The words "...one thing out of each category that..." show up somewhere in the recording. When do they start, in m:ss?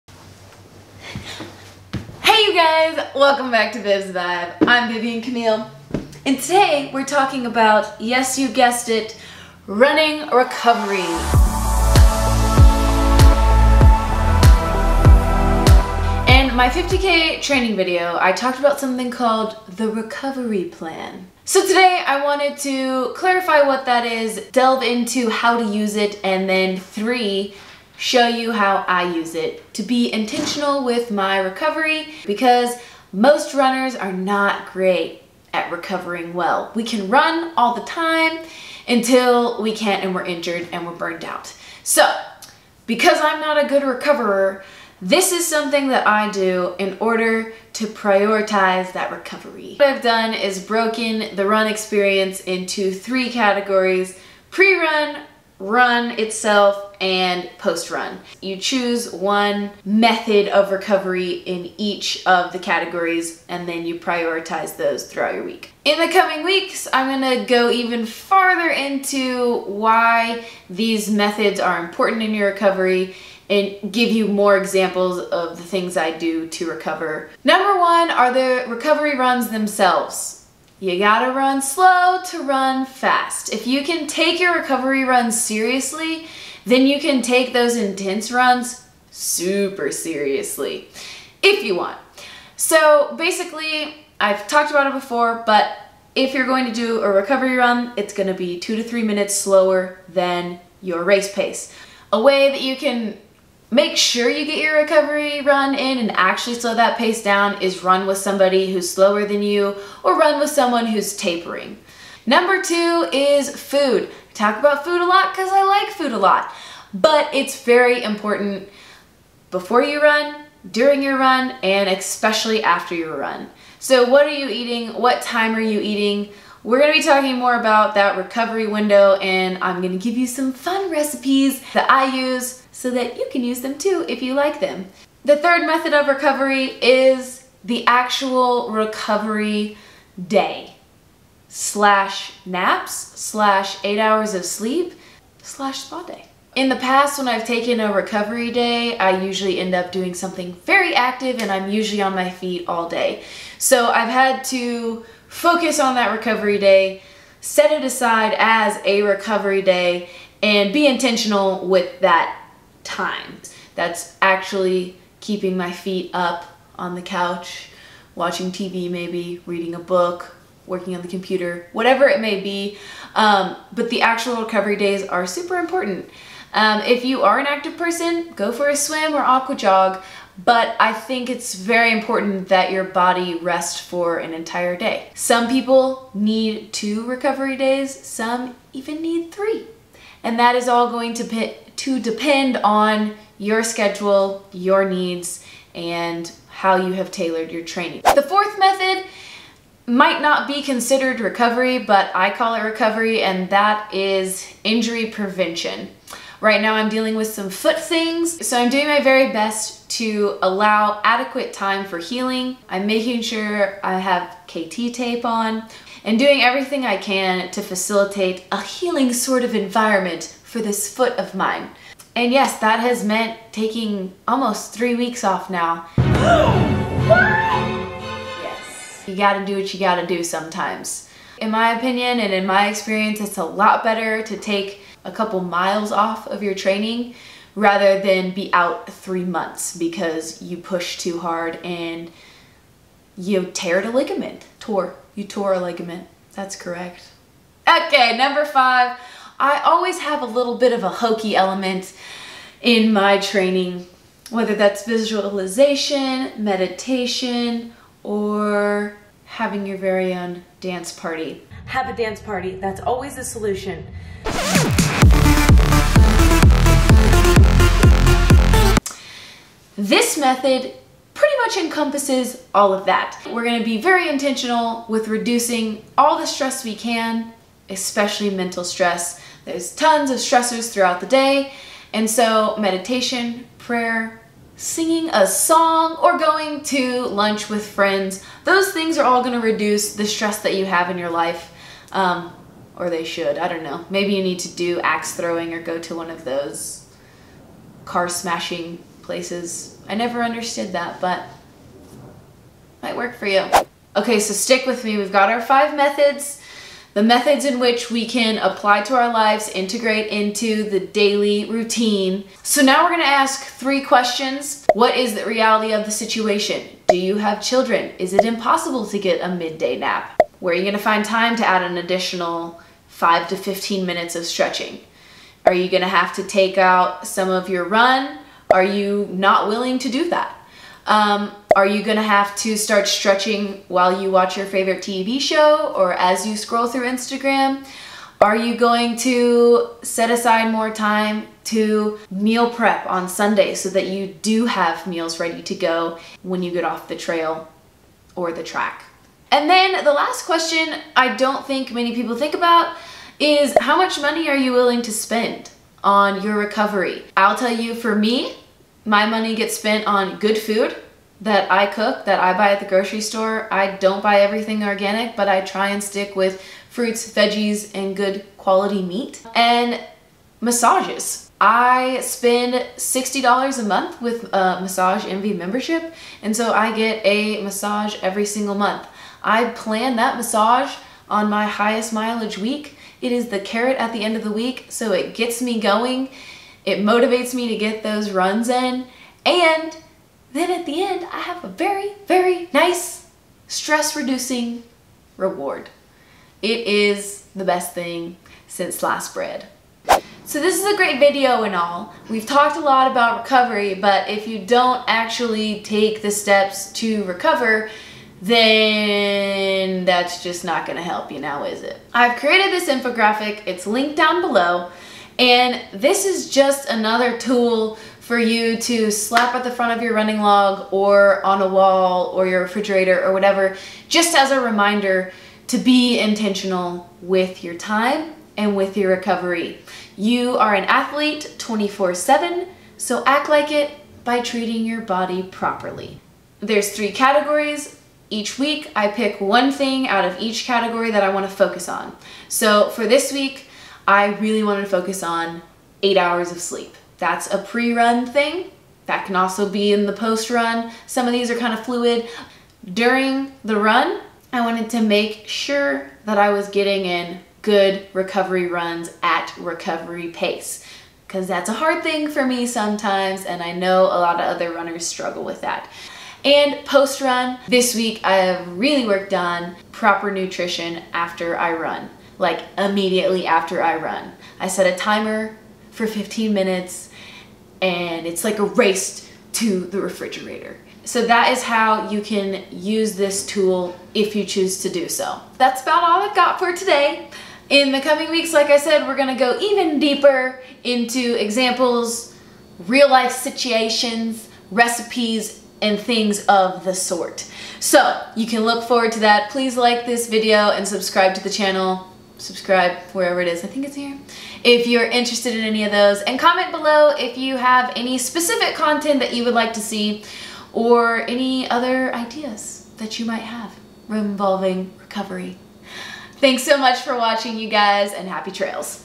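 7:19.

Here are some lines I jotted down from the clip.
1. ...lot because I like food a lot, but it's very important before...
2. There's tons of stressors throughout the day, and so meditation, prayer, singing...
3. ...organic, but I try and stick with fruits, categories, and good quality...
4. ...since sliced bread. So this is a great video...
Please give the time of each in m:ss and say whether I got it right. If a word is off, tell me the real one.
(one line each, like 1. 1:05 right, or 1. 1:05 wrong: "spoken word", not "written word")
1. 1:55 right
2. 4:39 right
3. 6:04 wrong: "veggies", not "categories"
4. 6:38 right.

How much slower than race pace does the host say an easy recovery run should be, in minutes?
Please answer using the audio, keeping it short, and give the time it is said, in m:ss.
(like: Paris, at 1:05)
2 to 3 minutes, at 1:38.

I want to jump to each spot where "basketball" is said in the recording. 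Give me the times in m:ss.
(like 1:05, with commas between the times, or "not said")
not said.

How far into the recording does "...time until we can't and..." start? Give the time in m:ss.
0:37.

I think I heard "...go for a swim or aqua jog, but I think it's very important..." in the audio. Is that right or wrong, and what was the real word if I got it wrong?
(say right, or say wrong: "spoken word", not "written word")
right.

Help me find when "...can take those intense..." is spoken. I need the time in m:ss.
1:26.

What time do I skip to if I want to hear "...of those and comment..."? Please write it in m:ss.
8:25.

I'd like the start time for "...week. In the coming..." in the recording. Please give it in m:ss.
1:05.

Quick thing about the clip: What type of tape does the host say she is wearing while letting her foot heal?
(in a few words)
KT tape.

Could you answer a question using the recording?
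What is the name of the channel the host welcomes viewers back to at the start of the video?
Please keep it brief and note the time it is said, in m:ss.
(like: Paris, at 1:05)
Viv's Vibe, at 0:03.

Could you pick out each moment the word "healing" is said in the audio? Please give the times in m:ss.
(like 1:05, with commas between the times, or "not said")
3:31, 3:38.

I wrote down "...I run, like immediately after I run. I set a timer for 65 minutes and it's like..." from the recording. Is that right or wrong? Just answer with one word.
wrong.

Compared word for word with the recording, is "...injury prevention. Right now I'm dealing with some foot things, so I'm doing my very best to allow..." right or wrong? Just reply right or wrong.
right.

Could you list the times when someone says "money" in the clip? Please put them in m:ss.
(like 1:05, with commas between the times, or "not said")
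5:53, 5:59.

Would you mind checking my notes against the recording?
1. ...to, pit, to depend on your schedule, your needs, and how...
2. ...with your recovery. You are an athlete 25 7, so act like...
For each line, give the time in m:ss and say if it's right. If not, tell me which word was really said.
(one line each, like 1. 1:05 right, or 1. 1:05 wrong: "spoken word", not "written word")
1. 3:11 right
2. 7:08 wrong: "24", not "25".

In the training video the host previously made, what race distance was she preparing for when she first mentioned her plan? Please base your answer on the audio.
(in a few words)
50k.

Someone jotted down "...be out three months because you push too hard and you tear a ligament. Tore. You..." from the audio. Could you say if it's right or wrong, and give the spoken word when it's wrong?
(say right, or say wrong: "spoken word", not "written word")
right.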